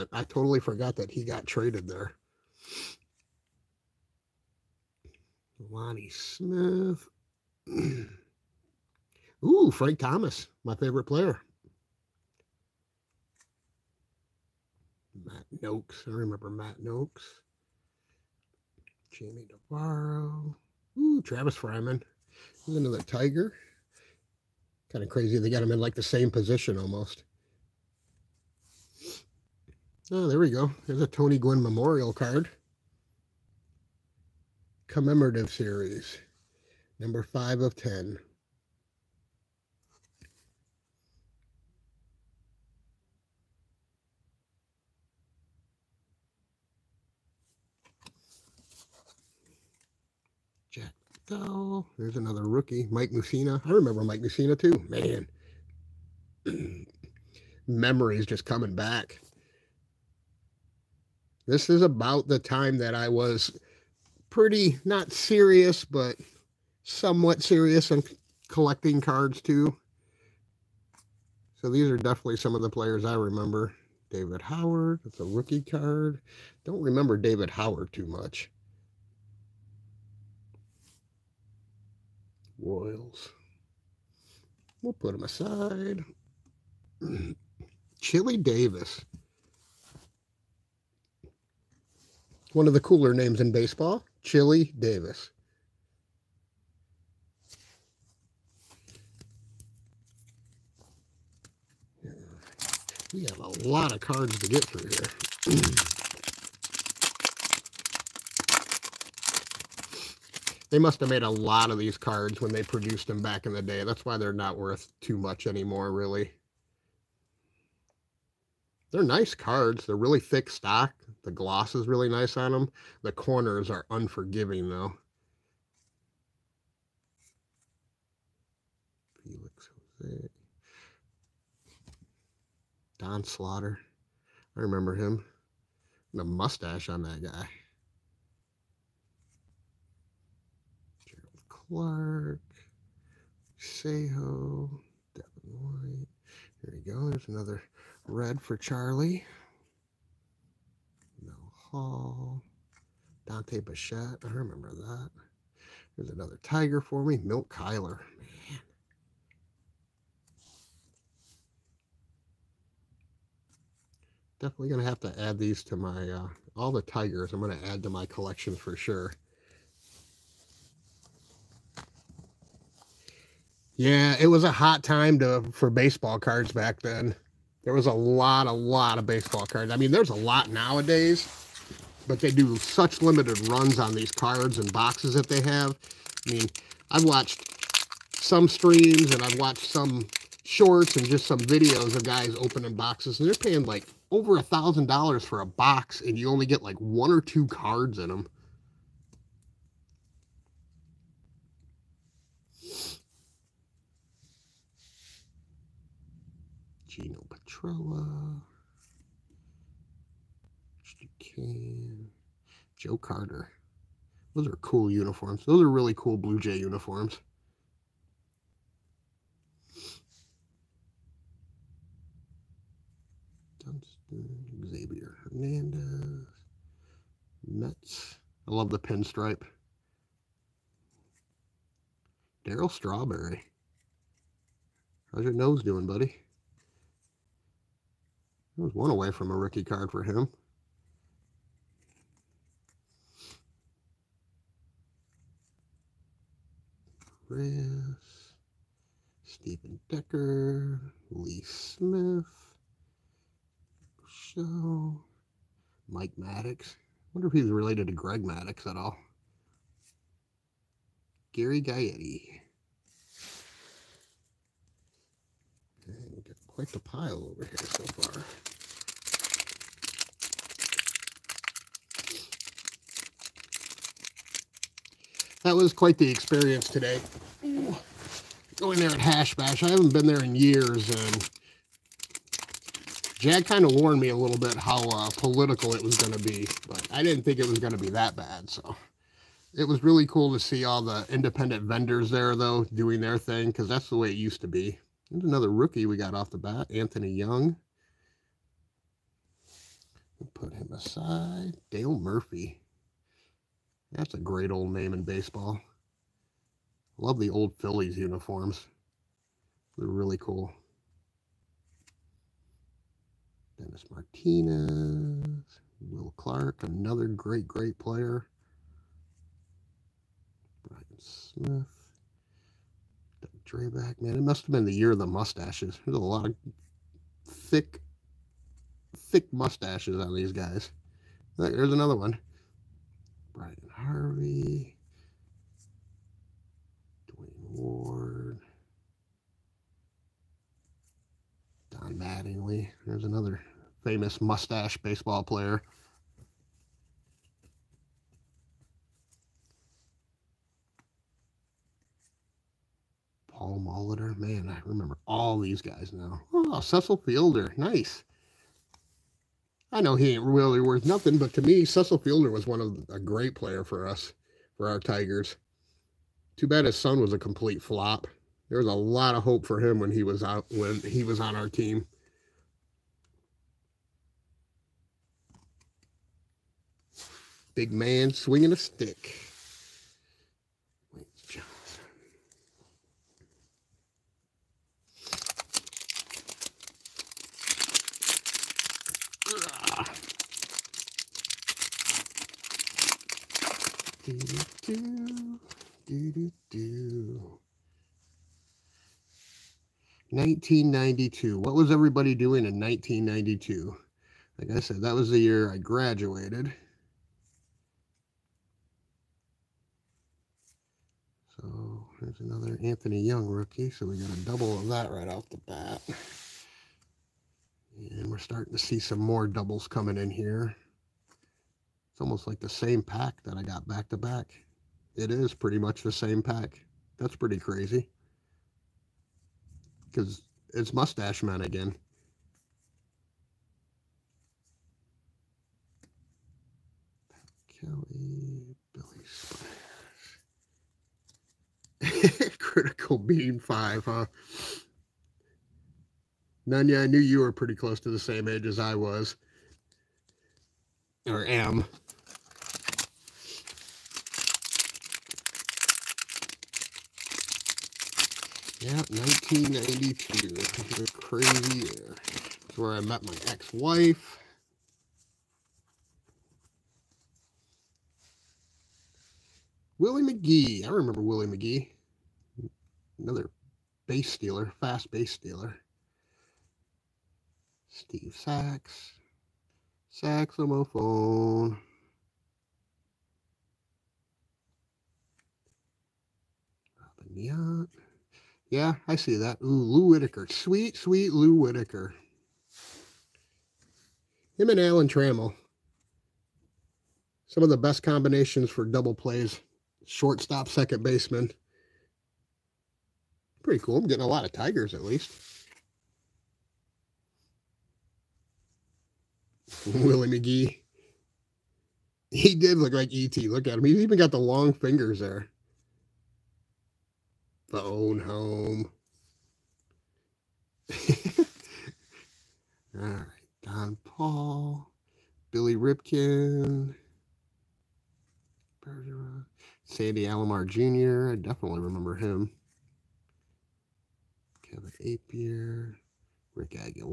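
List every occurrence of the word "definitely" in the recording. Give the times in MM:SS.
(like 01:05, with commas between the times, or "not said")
01:11, 02:44, 08:51.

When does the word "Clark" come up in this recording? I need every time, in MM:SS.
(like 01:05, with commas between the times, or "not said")
02:21, 05:16.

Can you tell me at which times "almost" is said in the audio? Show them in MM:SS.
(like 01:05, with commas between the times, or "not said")
00:26, 07:02.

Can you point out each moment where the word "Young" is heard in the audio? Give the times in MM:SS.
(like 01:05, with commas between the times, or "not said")
04:57, 06:53.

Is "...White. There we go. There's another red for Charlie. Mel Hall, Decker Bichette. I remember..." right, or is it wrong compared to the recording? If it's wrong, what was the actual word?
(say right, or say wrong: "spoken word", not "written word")
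wrong: "Dante", not "Decker".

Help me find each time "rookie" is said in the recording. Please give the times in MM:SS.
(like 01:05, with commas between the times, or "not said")
00:52, 01:15, 03:59, 04:55, 06:53.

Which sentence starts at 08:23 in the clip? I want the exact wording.
I'm getting a lot of Tigers at least.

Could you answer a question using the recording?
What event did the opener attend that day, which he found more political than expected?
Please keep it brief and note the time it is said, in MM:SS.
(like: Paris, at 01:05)
Hash Bash, at 04:38.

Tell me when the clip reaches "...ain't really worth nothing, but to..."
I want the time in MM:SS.
06:00.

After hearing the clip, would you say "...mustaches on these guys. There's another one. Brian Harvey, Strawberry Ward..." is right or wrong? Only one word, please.
wrong.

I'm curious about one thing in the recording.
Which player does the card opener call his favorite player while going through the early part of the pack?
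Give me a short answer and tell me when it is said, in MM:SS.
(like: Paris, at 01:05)
Frank Thomas, at 00:09.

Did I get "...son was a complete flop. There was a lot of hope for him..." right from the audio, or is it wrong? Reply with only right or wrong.
right.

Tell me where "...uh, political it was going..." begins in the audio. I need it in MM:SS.
04:44.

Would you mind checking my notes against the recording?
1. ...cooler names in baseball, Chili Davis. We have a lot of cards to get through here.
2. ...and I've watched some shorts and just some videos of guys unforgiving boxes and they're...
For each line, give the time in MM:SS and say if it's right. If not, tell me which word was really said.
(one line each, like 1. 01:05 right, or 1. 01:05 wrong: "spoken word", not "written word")
1. 01:32 right
2. 03:09 wrong: "opening", not "unforgiving".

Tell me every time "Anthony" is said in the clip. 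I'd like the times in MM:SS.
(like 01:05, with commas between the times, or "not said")
04:56, 06:52.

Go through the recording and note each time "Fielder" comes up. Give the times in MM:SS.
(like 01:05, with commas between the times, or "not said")
05:56, 06:01.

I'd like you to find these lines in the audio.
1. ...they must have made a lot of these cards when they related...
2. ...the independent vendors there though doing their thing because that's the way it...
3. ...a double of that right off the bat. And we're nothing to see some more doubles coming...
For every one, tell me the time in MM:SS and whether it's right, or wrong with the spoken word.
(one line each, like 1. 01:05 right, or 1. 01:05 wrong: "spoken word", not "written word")
1. 01:50 wrong: "produced", not "related"
2. 04:50 right
3. 06:54 wrong: "starting", not "nothing".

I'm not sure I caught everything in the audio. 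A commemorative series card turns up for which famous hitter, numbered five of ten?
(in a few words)
Tony Gwynn.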